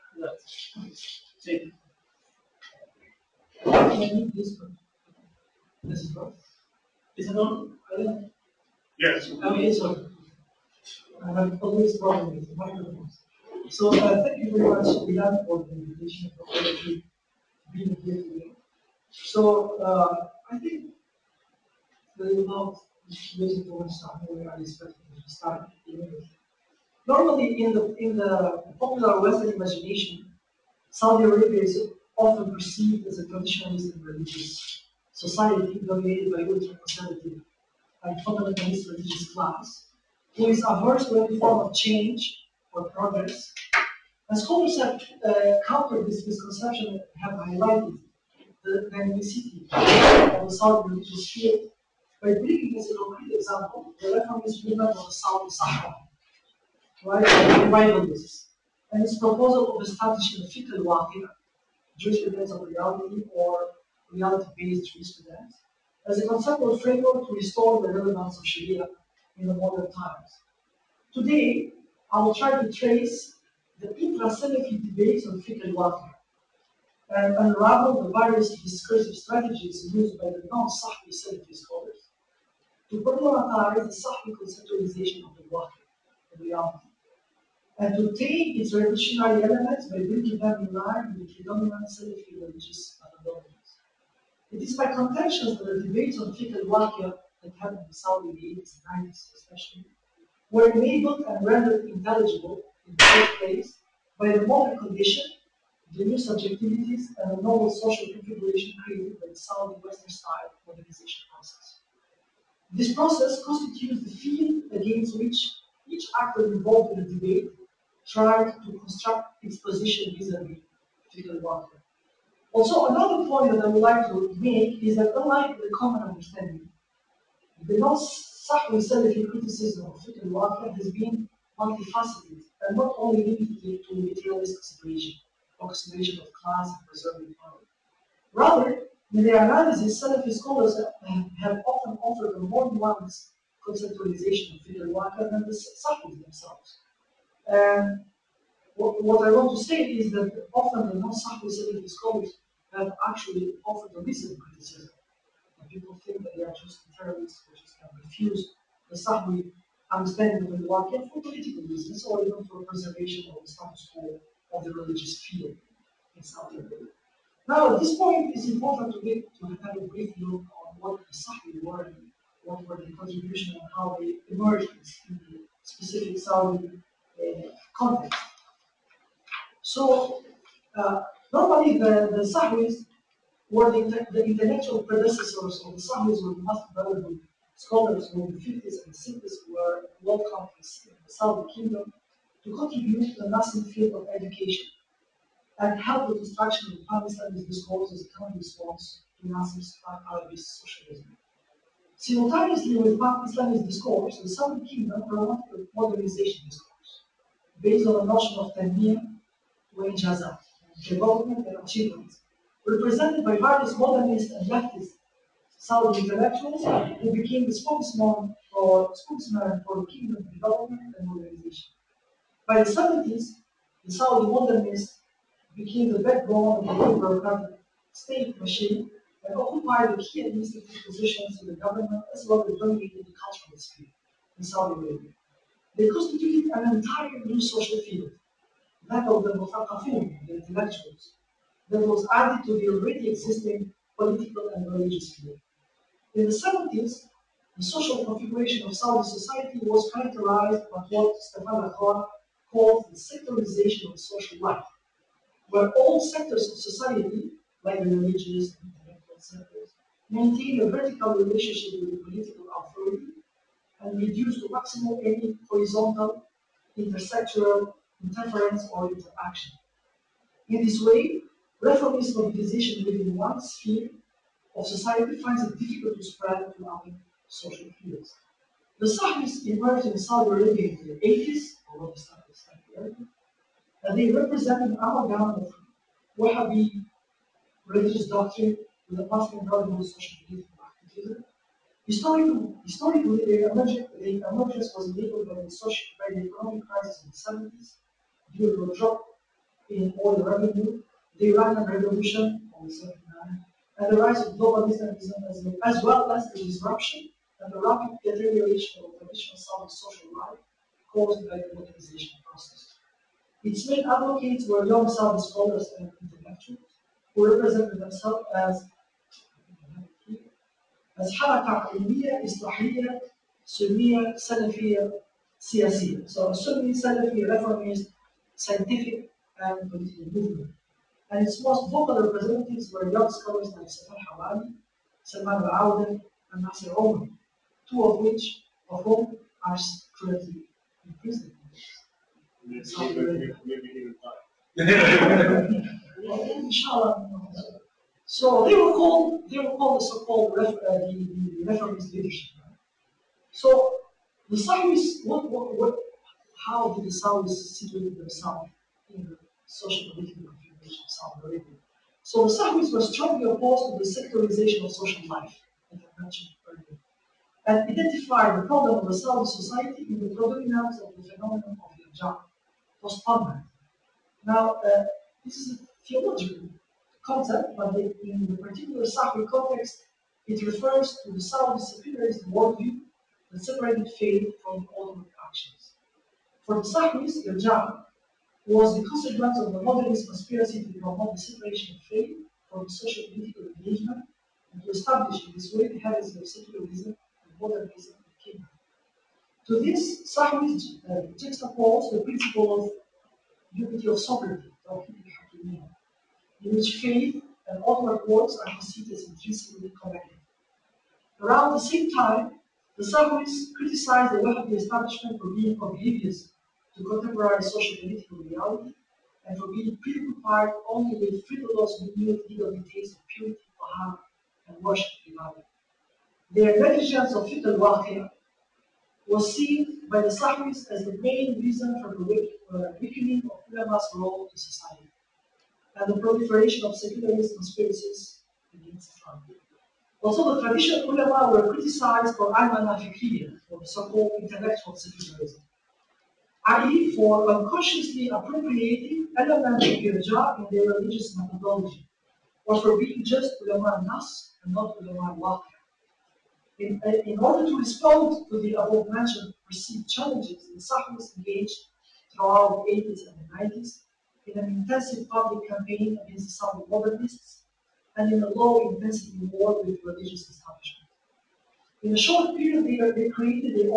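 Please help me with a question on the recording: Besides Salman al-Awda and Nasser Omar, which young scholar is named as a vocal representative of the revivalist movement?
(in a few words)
Safar Hawali.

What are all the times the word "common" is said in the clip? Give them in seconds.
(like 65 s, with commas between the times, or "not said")
125 s, 198 s.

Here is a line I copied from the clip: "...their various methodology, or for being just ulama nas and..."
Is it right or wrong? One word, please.
wrong.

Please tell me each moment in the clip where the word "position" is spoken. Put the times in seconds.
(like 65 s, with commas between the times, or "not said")
119 s, 230 s.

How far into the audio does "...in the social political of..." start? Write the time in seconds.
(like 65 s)
358 s.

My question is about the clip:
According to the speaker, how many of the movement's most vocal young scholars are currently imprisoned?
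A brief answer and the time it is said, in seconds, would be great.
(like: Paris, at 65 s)
2, at 337 s.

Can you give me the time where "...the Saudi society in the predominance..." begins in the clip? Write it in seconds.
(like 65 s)
368 s.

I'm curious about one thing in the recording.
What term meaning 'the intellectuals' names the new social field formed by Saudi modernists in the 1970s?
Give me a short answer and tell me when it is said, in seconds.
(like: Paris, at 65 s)
Muthaqafun, at 239 s.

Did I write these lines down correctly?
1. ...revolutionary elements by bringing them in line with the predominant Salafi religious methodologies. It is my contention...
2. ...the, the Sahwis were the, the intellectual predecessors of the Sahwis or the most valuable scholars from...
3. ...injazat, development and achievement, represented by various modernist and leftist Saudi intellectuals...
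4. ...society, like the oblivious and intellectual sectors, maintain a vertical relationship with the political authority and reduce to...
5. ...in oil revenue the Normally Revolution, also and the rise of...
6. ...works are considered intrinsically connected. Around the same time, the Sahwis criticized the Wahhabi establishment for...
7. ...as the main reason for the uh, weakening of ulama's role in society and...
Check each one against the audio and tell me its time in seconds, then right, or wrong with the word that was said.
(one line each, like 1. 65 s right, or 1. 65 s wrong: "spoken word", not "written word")
1. 88 s right
2. 181 s right
3. 209 s right
4. 256 s wrong: "religious", not "oblivious"
5. 299 s wrong: "Iranian", not "Normally"
6. 408 s right
7. 430 s right.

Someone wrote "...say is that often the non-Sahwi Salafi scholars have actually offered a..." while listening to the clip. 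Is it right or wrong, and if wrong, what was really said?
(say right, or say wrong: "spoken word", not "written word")
right.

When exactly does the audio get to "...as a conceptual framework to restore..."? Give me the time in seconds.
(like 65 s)
66 s.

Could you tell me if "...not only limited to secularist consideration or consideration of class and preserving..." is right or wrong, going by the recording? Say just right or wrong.
wrong.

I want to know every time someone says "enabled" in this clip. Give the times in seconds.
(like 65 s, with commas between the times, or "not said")
100 s, 294 s.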